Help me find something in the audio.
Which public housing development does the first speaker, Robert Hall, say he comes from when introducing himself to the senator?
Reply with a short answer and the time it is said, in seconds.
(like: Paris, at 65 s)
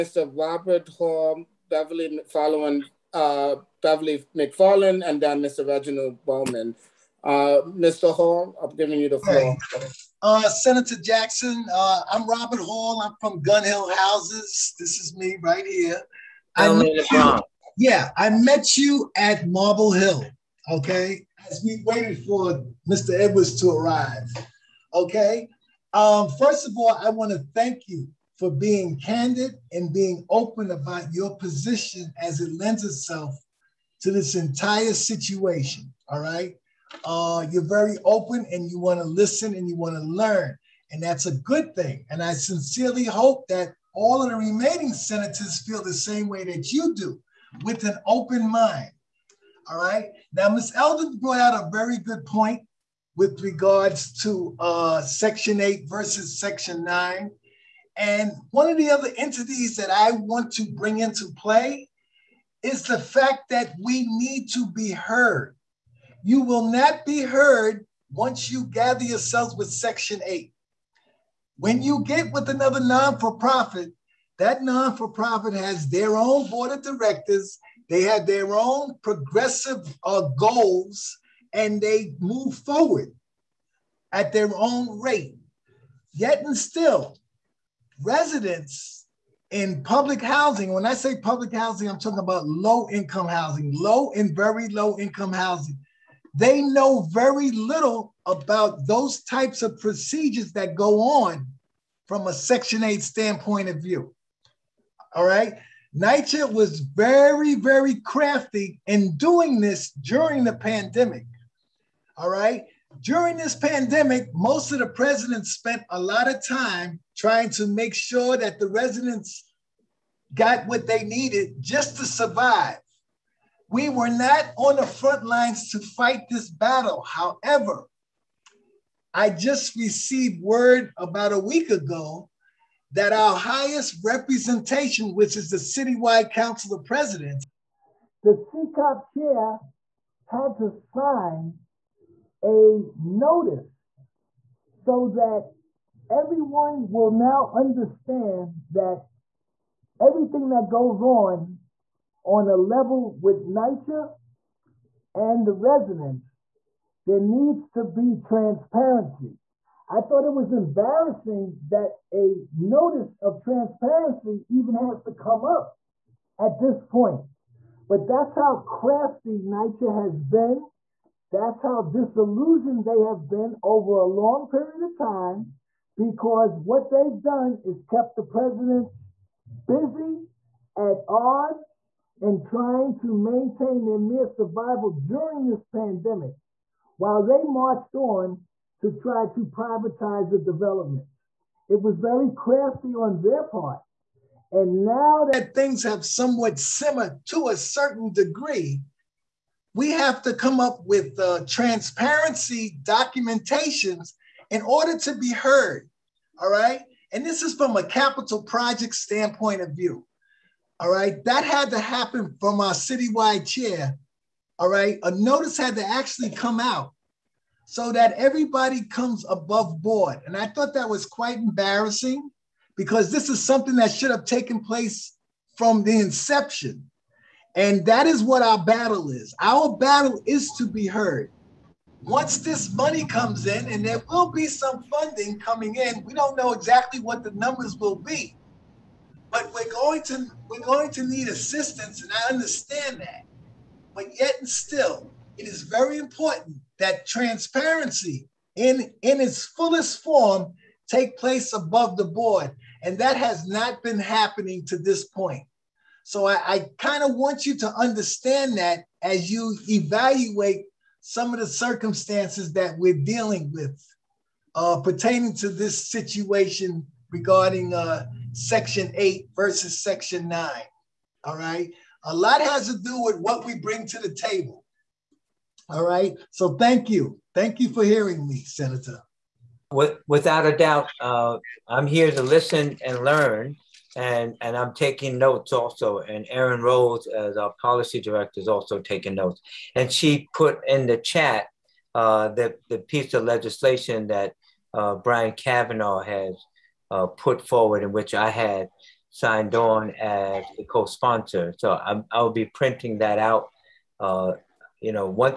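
Gun Hill Houses, at 13 s.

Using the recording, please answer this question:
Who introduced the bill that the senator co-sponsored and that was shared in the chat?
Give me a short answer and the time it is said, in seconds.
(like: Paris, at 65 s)
Brian Kavanagh, at 294 s.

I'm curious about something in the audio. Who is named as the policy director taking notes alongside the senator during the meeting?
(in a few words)
Erin Rose.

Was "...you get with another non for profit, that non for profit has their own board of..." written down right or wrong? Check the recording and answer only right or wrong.
right.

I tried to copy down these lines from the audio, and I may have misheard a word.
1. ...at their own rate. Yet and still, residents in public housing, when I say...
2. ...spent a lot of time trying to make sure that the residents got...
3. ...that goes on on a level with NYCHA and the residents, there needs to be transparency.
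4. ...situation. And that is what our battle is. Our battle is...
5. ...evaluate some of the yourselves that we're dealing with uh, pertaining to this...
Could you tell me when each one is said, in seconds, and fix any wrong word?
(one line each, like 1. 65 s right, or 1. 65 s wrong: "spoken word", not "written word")
1. 84 s right
2. 115 s right
3. 150 s right
4. 226 s wrong: "inception", not "situation"
5. 259 s wrong: "circumstances", not "yourselves".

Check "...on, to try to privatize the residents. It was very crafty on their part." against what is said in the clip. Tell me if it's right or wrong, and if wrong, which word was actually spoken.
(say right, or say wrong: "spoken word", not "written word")
wrong: "developments", not "residents".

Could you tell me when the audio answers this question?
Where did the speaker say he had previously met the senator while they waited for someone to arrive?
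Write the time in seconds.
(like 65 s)
19 s.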